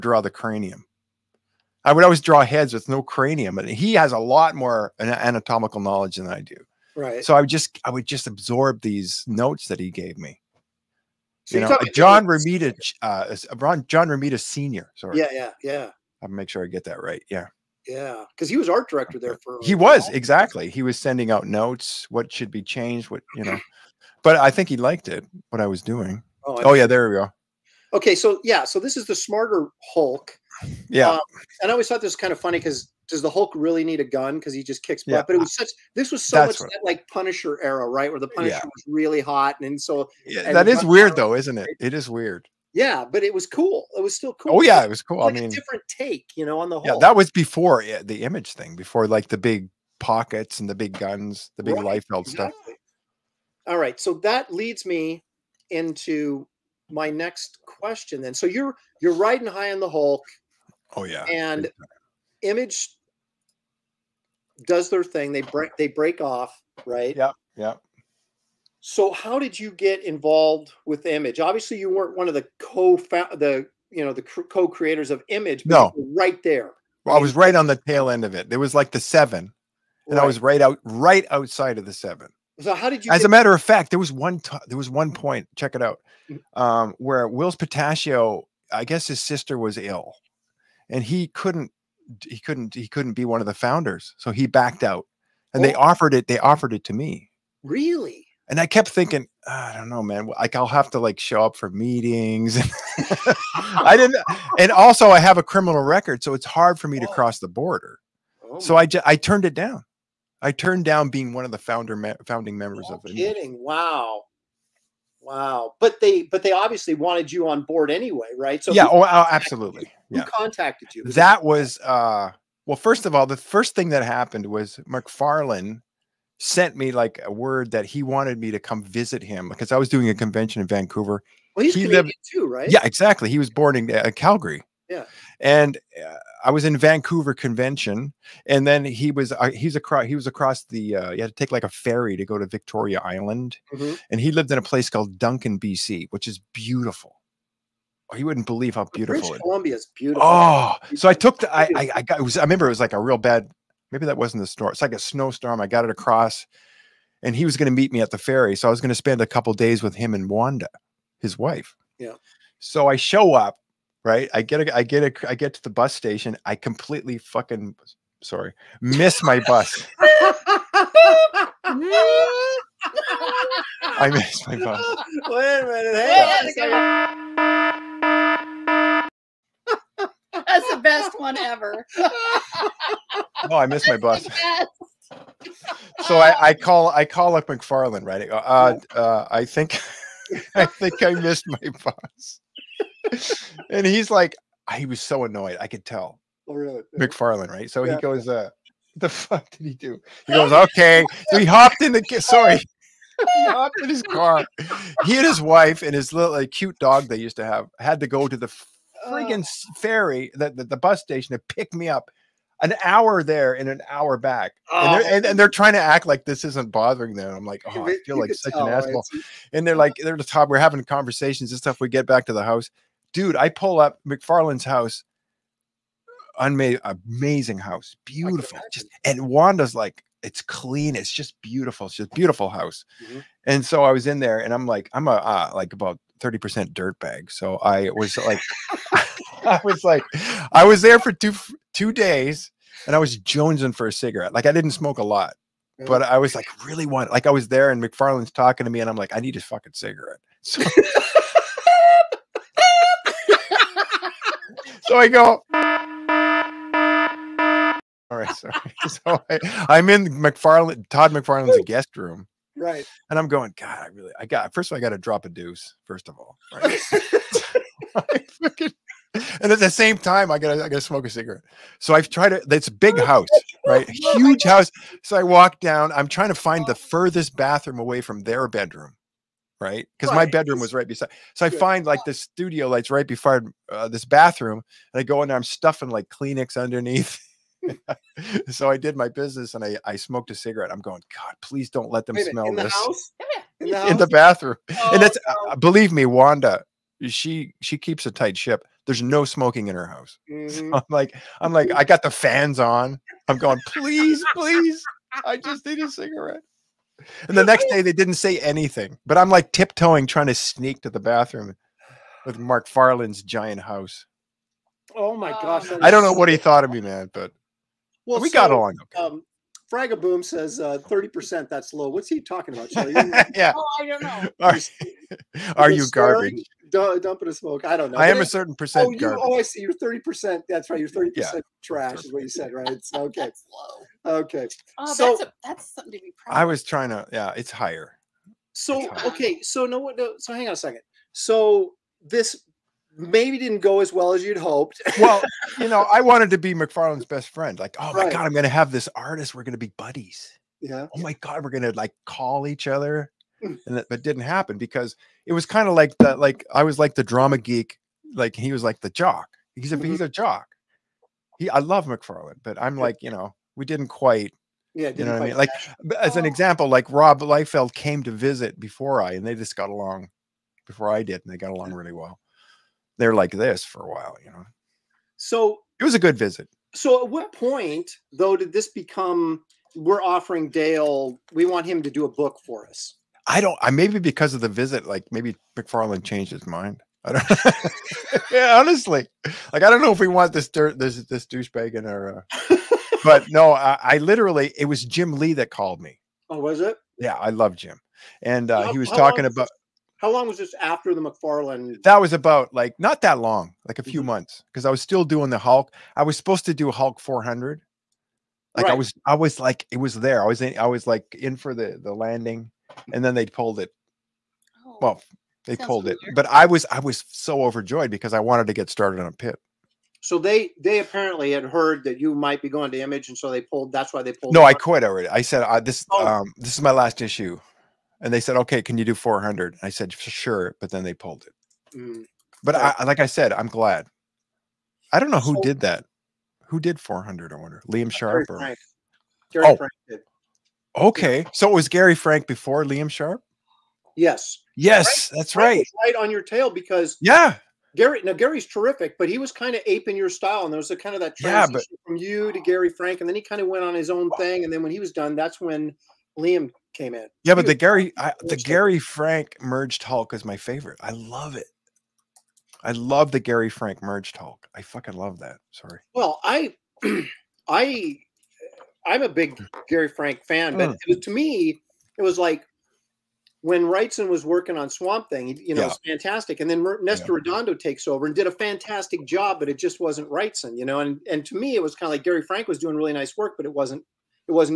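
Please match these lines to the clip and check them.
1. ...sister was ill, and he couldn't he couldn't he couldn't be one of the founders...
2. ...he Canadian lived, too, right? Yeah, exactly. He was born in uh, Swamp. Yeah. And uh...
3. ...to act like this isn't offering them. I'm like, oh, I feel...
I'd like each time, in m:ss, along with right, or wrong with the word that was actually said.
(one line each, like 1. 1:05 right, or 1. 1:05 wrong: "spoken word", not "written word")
1. 1:29 right
2. 2:11 wrong: "Calgary", not "Swamp"
3. 3:35 wrong: "bothering", not "offering".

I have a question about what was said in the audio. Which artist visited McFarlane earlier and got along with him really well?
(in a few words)
Rob Liefeld.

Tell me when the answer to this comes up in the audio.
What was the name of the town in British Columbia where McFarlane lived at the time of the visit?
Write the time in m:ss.
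2:25.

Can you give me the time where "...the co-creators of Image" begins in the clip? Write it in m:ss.
1:14.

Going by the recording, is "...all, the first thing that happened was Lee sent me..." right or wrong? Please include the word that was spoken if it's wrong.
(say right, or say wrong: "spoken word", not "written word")
wrong: "McFarlane", not "Lee".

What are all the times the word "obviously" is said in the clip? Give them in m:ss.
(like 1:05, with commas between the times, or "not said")
1:11, 1:56.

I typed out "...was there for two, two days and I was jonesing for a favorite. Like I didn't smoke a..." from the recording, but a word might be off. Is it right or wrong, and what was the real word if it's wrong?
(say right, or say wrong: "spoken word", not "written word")
wrong: "cigarette", not "favorite".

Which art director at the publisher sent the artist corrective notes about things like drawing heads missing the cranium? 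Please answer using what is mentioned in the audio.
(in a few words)
John Romita Senior.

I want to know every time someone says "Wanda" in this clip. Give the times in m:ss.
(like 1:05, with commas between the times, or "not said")
2:40, 3:49, 4:56.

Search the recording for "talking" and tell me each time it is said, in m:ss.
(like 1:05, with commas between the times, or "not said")
4:08, 5:22, 6:38.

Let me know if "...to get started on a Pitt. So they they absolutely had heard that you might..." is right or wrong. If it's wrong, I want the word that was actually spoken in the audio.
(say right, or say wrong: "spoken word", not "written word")
wrong: "apparently", not "absolutely".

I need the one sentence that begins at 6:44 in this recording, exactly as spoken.
months, because I was still doing the Hulk.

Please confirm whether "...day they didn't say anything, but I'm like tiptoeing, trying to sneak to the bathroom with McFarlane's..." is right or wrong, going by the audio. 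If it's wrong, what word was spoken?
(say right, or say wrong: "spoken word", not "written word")
right.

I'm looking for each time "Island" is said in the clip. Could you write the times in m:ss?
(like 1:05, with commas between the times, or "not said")
2:23.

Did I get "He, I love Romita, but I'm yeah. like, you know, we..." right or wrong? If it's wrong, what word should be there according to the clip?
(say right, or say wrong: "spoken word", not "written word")
wrong: "McFarlane", not "Romita".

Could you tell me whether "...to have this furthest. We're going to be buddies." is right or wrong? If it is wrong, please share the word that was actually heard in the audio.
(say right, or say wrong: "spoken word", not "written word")
wrong: "artist", not "furthest".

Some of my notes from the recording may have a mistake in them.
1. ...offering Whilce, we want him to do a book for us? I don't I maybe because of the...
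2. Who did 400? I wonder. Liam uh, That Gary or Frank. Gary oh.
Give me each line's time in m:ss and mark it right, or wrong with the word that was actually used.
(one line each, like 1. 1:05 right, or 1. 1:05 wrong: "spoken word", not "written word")
1. 6:19 wrong: "Dale", not "Whilce"
2. 7:16 wrong: "Sharp", not "That".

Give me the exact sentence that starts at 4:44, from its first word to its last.
And I go in there, I'm stuffing like Kleenex underneath.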